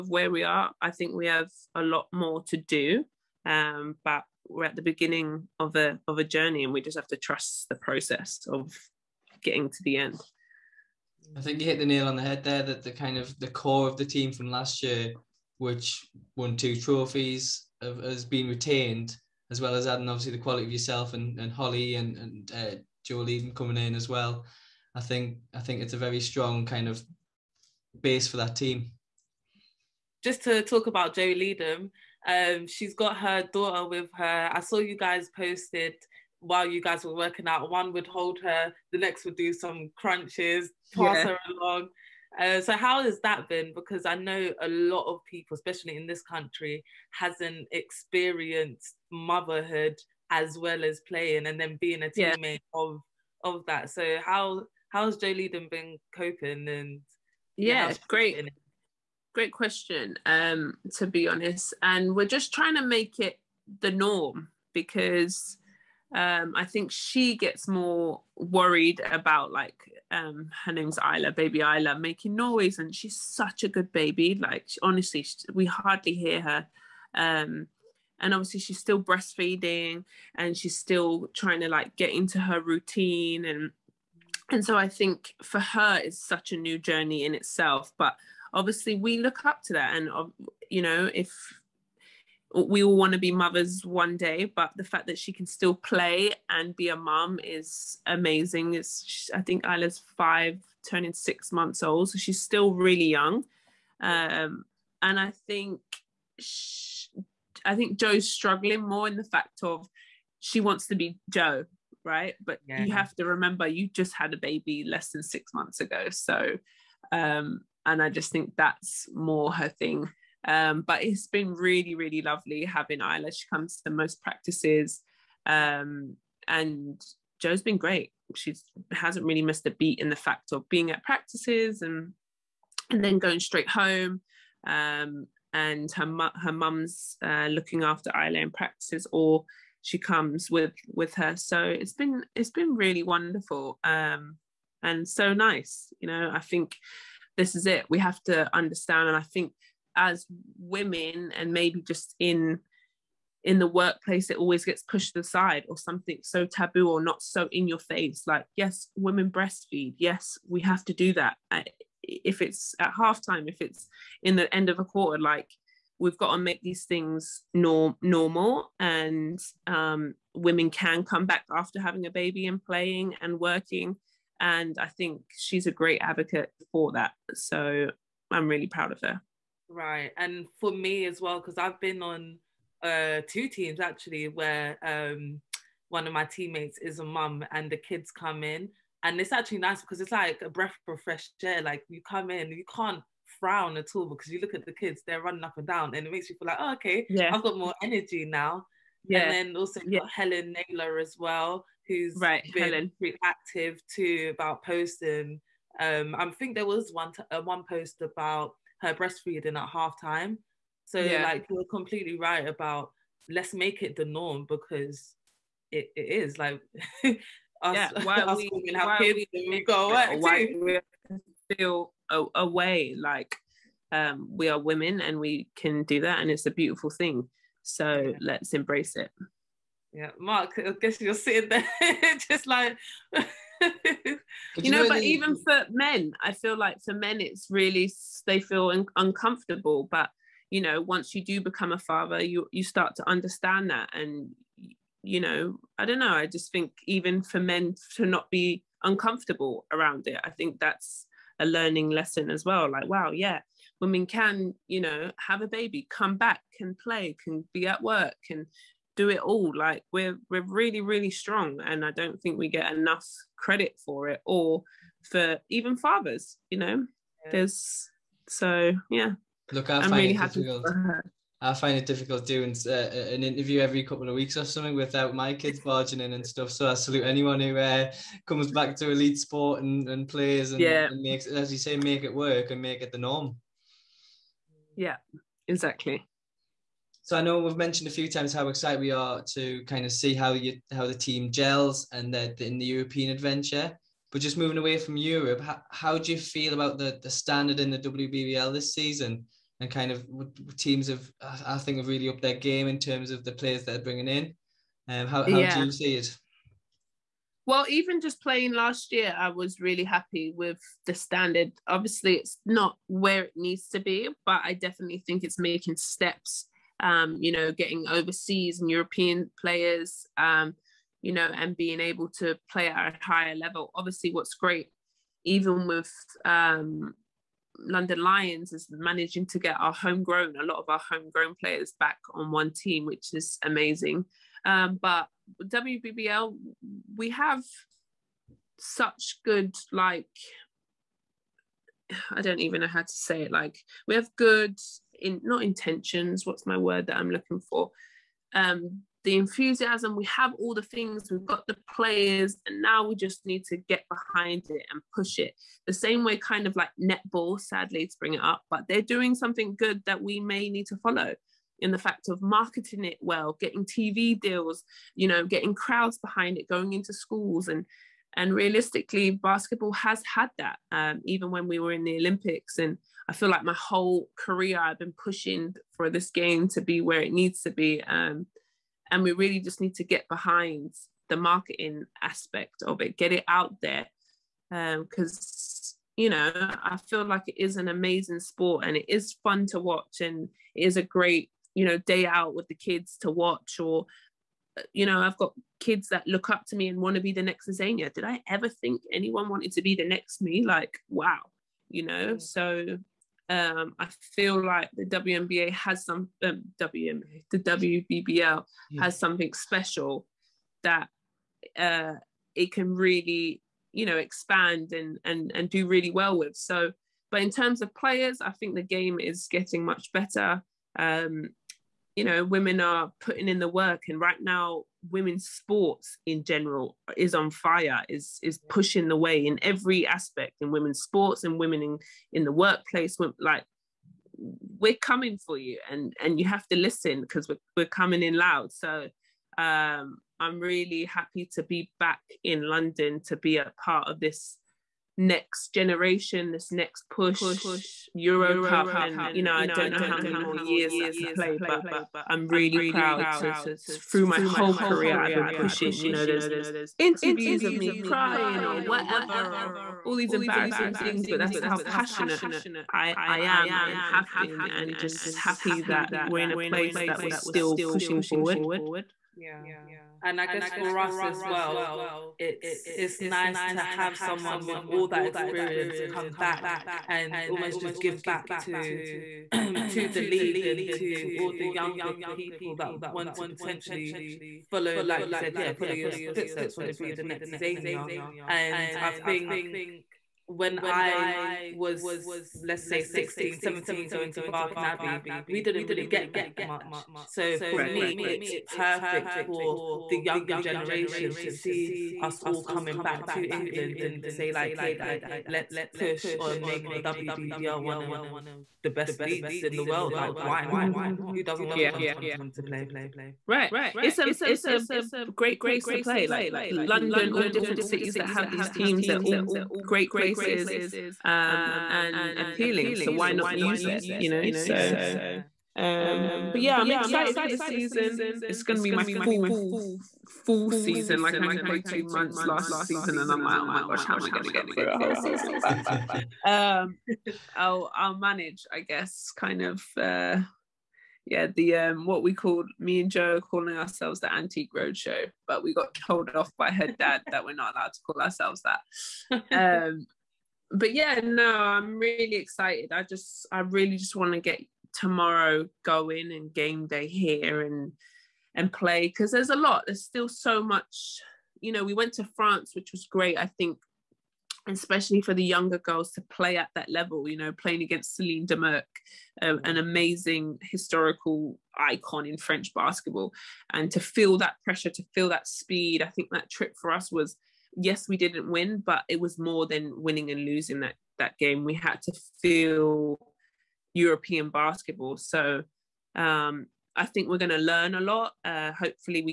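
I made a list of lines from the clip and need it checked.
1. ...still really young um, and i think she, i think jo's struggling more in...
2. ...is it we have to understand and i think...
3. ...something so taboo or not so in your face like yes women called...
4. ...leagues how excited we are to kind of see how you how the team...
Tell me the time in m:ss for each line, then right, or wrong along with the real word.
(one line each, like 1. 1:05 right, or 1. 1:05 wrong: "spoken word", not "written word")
1. 1:42 right
2. 2:27 right
3. 2:35 wrong: "breastfeed", not "called"
4. 4:48 wrong: "times", not "leagues".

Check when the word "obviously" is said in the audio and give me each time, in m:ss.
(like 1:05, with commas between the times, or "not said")
0:20, 1:18, 1:28, 5:11, 5:23.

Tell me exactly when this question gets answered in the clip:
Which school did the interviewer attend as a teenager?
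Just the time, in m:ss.
8:14.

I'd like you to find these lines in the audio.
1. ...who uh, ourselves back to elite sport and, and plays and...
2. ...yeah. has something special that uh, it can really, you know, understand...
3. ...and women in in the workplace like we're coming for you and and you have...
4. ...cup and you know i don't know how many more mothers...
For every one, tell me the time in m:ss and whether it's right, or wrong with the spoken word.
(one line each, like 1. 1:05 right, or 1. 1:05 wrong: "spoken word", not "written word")
1. 4:37 wrong: "comes", not "ourselves"
2. 6:48 wrong: "expand", not "understand"
3. 7:11 right
4. 7:28 wrong: "years", not "mothers".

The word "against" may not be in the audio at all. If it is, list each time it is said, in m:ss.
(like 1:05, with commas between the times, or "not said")
9:27.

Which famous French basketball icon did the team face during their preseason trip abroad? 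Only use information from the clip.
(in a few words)
Celine Dumerc.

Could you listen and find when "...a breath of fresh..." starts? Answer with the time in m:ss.
3:10.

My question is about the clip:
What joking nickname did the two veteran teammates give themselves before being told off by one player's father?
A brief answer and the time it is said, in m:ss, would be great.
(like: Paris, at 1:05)
Antique Roadshow, at 9:04.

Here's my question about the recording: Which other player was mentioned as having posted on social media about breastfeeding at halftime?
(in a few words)
Helen Naylor.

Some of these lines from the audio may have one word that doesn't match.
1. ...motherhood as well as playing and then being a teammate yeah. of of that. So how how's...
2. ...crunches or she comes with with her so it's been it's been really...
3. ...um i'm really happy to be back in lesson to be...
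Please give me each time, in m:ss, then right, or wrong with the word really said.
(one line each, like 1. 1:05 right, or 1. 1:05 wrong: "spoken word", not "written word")
1. 0:49 right
2. 2:18 wrong: "practices", not "crunches"
3. 7:19 wrong: "london", not "lesson".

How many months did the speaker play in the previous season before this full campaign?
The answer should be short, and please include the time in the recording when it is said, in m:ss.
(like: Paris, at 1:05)
2, at 8:51.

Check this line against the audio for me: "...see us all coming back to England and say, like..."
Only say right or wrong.
right.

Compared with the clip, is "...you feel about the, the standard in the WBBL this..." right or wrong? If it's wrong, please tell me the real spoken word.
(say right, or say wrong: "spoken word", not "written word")
right.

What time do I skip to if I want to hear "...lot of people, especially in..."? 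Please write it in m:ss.
0:44.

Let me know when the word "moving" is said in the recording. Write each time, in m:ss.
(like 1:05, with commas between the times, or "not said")
4:54.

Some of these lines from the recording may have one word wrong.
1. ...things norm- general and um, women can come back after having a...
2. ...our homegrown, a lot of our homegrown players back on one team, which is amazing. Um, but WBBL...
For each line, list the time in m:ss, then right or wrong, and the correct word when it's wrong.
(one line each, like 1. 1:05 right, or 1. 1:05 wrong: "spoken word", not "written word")
1. 2:46 wrong: "normal", not "general"
2. 5:29 right.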